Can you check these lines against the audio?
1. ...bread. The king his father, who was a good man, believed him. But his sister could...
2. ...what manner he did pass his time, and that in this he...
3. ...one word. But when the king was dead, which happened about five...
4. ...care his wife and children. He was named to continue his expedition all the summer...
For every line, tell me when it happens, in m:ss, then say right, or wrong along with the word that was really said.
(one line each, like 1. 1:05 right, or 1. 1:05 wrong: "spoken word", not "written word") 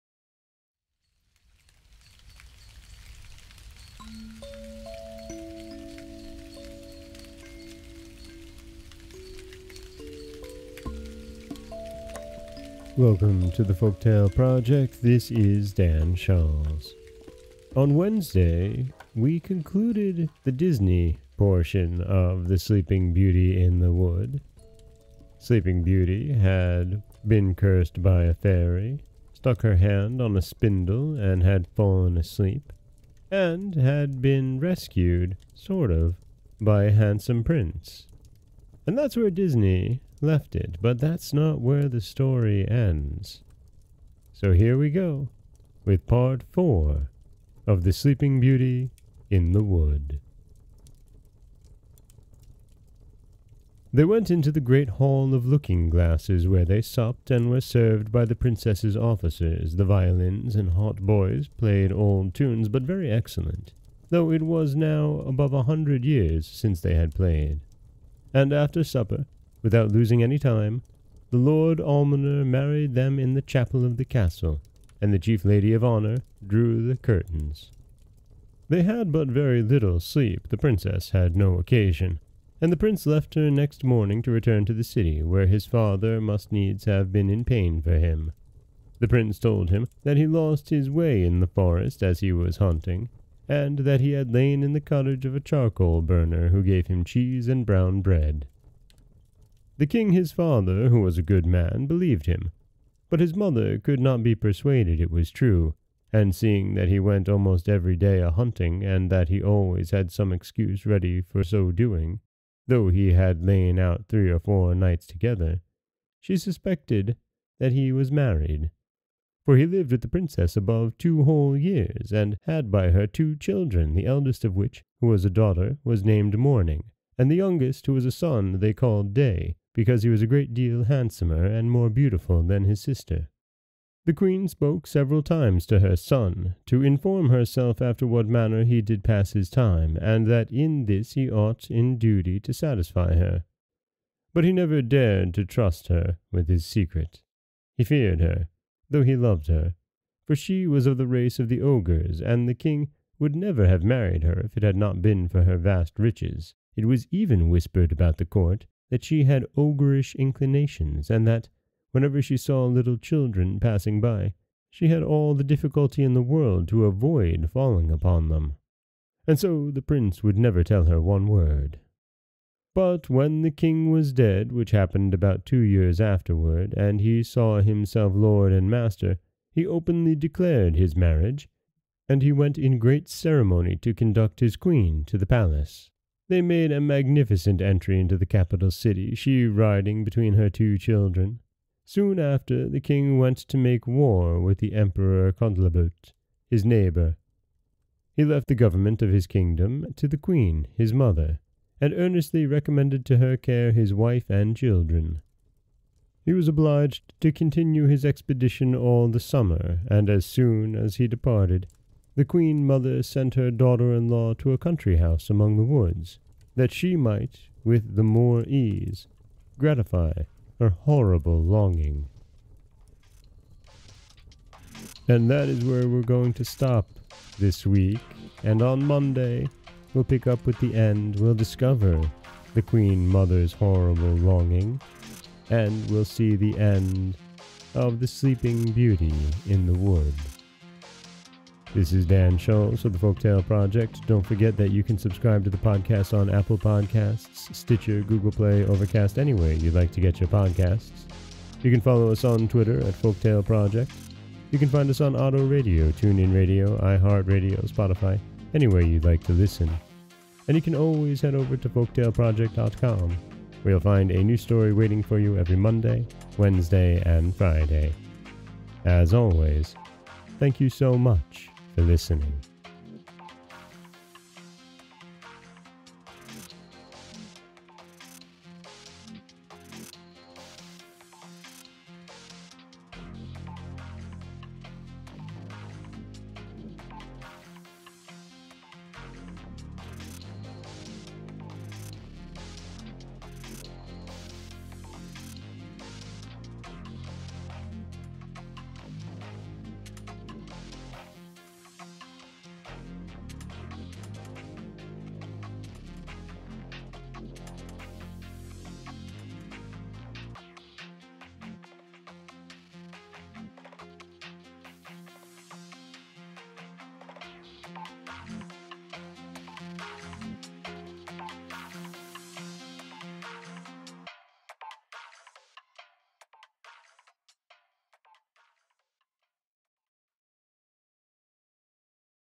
1. 1:38 wrong: "mother", not "sister"
2. 2:18 right
3. 2:51 wrong: "two", not "five"
4. 3:23 wrong: "obliged", not "named".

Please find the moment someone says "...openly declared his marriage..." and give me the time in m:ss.
2:59.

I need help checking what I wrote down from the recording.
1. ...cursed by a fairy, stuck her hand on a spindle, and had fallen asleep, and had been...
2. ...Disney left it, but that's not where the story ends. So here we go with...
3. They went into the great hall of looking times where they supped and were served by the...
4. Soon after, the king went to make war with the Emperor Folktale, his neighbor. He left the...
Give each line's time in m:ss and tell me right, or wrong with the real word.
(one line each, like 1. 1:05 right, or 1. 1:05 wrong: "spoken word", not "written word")
1. 0:27 right
2. 0:39 right
3. 0:53 wrong: "glasses", not "times"
4. 3:11 wrong: "Cantalabutte", not "Folktale".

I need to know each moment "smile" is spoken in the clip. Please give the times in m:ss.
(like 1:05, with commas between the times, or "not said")
not said.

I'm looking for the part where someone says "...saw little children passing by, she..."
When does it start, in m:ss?
2:42.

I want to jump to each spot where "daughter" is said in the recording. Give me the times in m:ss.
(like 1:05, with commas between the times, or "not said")
2:05, 3:33.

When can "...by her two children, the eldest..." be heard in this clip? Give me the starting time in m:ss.
2:02.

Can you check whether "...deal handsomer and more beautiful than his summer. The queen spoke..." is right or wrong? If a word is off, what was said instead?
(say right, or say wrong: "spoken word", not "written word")
wrong: "sister", not "summer".